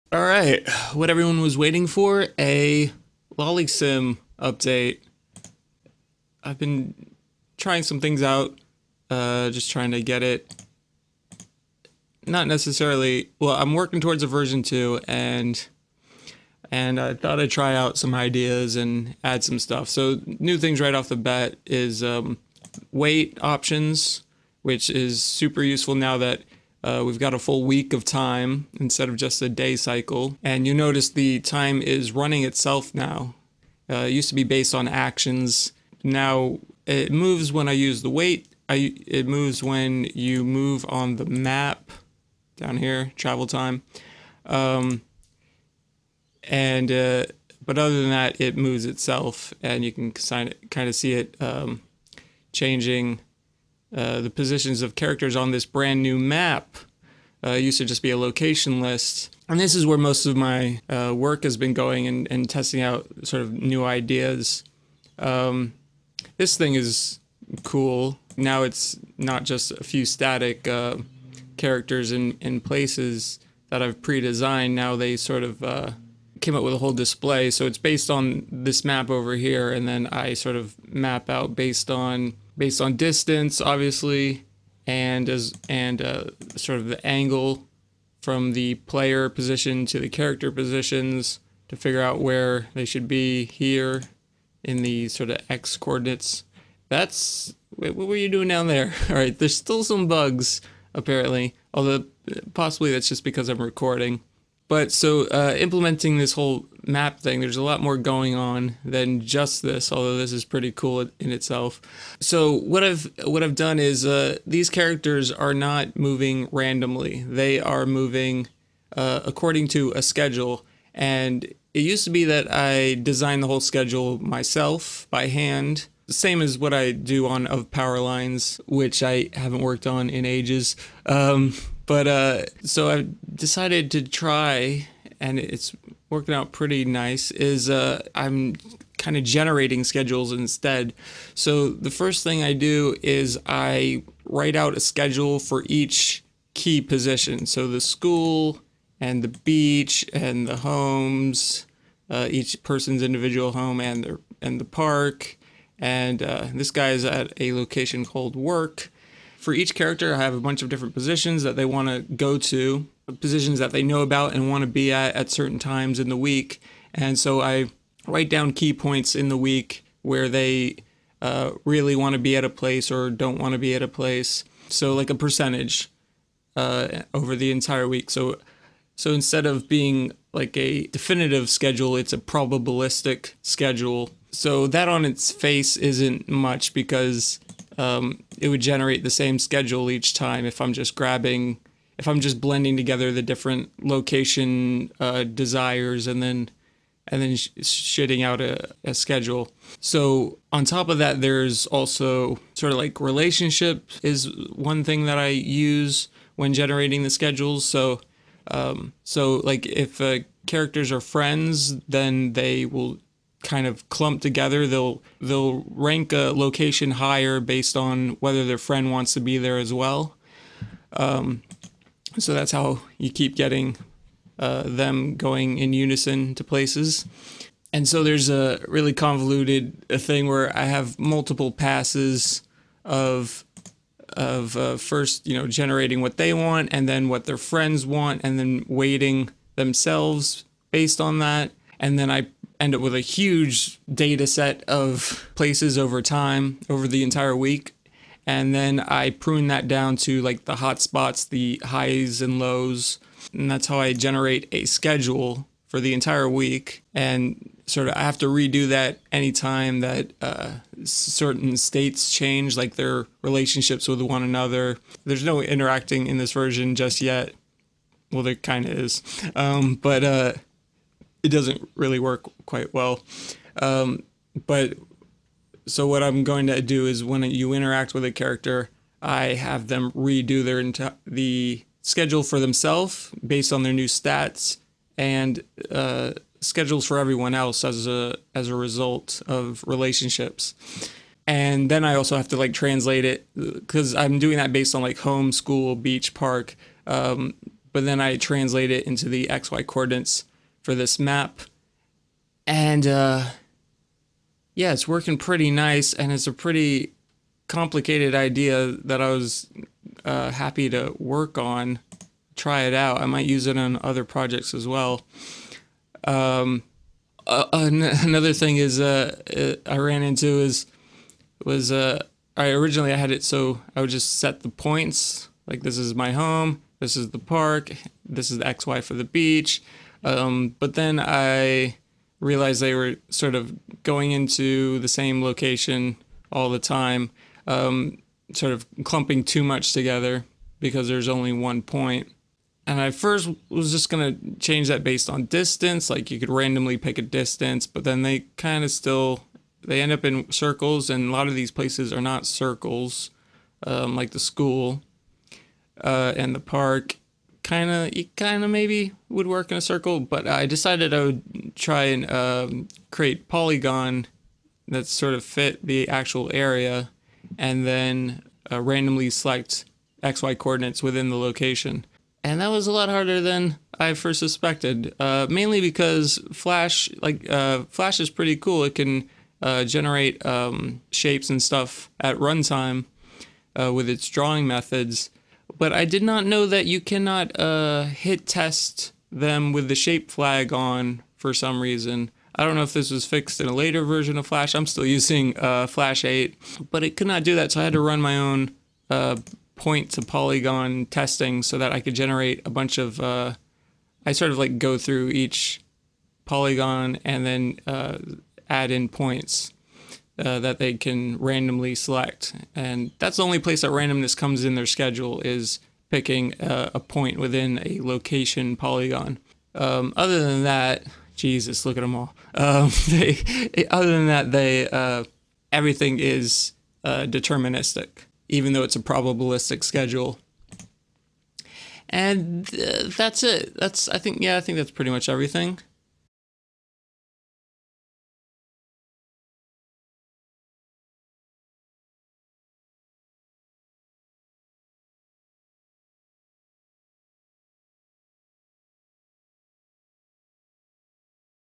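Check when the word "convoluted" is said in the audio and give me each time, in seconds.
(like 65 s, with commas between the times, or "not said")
228 s.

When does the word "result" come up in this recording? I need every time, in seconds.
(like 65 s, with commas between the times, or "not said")
288 s.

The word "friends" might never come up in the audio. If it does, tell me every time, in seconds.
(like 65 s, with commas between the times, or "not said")
211 s, 218 s, 237 s.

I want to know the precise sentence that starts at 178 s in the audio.
So so instead of being like a definitive schedule, it's a probabilistic schedule.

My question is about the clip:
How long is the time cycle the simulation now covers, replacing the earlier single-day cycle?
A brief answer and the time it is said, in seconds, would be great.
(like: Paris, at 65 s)
a full week, at 27 s.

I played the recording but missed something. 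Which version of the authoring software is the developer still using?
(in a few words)
Flash 8.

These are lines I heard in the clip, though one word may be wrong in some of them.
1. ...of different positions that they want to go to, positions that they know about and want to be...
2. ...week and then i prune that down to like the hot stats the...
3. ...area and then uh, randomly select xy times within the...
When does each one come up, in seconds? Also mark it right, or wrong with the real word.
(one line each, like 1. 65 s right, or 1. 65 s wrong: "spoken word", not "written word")
1. 160 s right
2. 247 s wrong: "spots", not "stats"
3. 366 s wrong: "coordinates", not "times".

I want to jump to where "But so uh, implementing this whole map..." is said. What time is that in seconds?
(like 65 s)
104 s.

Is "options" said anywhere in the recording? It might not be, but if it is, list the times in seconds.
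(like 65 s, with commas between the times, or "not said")
23 s.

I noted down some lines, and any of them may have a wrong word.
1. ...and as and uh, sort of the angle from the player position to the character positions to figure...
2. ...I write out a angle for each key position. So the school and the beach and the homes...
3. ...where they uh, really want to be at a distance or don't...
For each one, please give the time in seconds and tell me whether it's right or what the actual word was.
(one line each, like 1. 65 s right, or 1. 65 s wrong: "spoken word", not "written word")
1. 84 s right
2. 143 s wrong: "schedule", not "angle"
3. 170 s wrong: "place", not "distance".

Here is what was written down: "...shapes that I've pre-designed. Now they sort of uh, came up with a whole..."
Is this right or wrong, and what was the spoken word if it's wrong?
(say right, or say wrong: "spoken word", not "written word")
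wrong: "places", not "shapes".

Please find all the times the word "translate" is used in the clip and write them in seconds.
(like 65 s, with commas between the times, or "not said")
292 s, 298 s.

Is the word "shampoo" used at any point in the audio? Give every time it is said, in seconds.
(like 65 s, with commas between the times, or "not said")
not said.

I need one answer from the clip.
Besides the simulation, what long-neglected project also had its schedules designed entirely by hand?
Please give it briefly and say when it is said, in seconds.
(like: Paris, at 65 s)
Power Lines, at 127 s.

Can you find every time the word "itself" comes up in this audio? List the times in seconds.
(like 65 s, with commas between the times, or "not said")
32 s, 48 s, 111 s.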